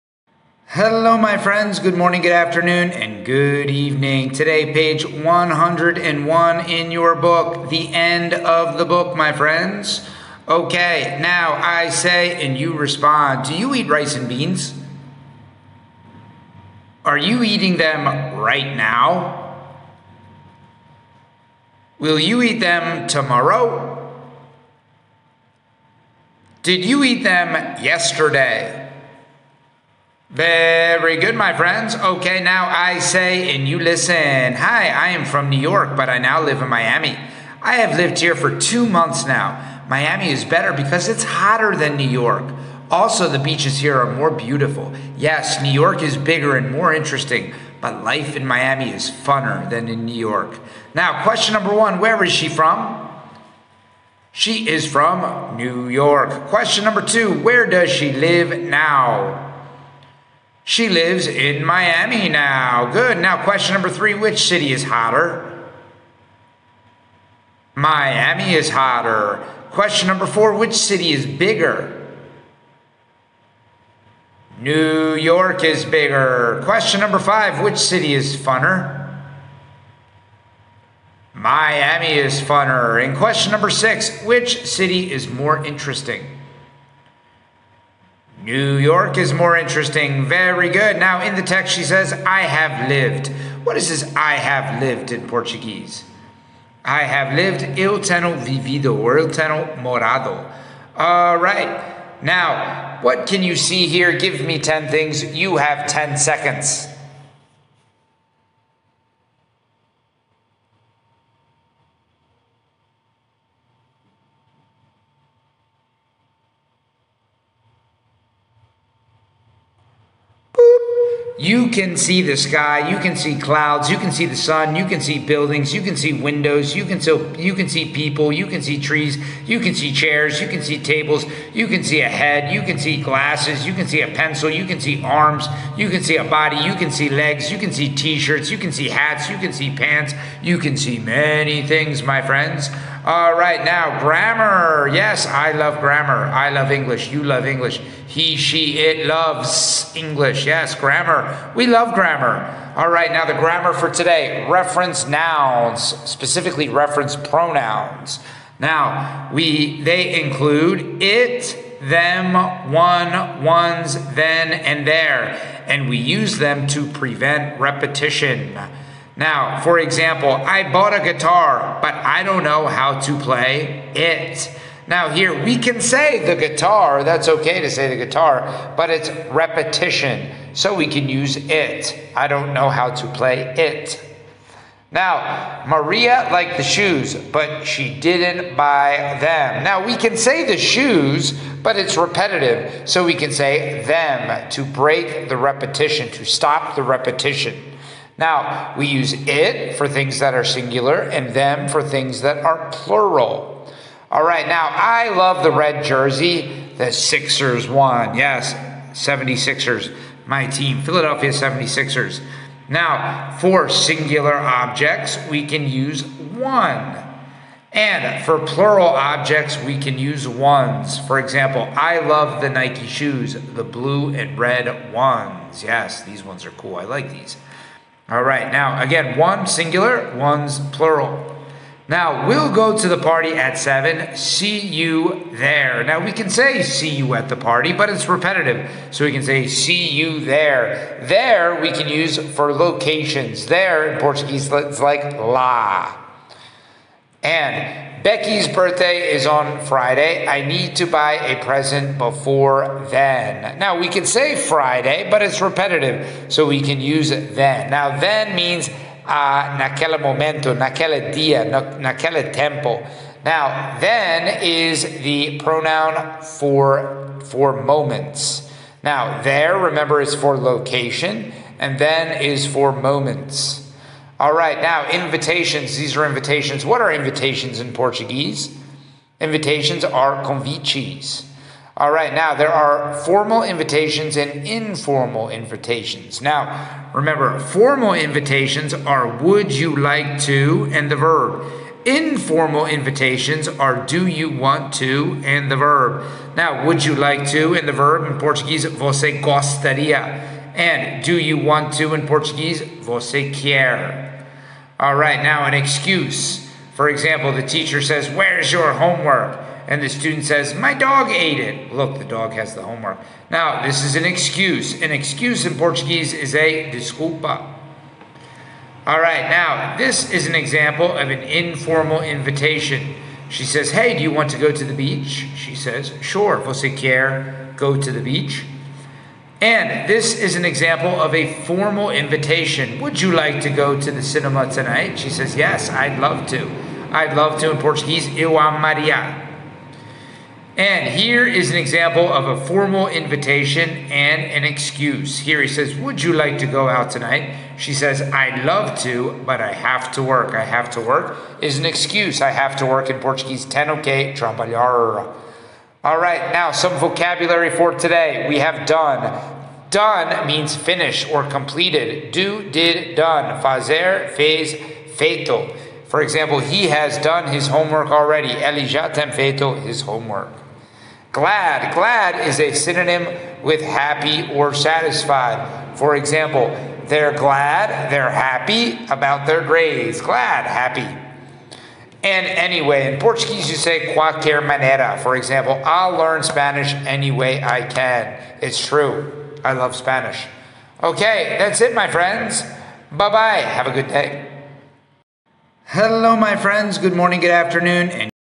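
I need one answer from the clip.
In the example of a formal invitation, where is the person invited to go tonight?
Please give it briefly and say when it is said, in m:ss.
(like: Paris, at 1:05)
The cinema, at 5:33.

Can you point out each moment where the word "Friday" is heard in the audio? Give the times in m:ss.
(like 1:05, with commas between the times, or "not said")
4:09, 4:14.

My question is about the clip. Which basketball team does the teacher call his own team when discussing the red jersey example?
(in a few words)
Philadelphia 76ers.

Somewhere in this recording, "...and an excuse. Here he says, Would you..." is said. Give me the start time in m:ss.
5:43.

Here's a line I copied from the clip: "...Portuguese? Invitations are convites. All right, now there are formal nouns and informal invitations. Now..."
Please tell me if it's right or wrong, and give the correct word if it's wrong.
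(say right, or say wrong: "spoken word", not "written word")
wrong: "invitations", not "nouns".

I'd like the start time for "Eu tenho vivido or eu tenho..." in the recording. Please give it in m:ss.
1:37.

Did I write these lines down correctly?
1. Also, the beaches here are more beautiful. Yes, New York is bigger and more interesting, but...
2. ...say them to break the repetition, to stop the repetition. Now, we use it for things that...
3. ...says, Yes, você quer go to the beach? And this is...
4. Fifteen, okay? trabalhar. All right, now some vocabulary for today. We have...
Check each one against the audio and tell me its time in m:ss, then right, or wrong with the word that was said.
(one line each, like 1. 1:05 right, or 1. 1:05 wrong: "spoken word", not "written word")
1. 0:42 right
2. 3:13 right
3. 5:25 wrong: "Sure", not "Yes"
4. 5:53 wrong: "Ten", not "Fifteen".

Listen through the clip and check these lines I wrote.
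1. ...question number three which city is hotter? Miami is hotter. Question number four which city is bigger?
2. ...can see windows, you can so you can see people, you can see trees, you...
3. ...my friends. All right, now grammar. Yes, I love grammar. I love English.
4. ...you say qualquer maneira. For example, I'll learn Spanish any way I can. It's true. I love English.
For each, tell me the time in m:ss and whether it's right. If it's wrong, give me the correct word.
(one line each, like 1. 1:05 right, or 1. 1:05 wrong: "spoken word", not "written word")
1. 1:03 right
2. 2:05 right
3. 2:22 right
4. 6:23 wrong: "Spanish", not "English".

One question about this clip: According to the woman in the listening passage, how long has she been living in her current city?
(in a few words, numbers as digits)
2 months.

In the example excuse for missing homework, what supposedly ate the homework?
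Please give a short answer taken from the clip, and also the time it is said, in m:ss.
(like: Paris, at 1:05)
My dog, at 5:10.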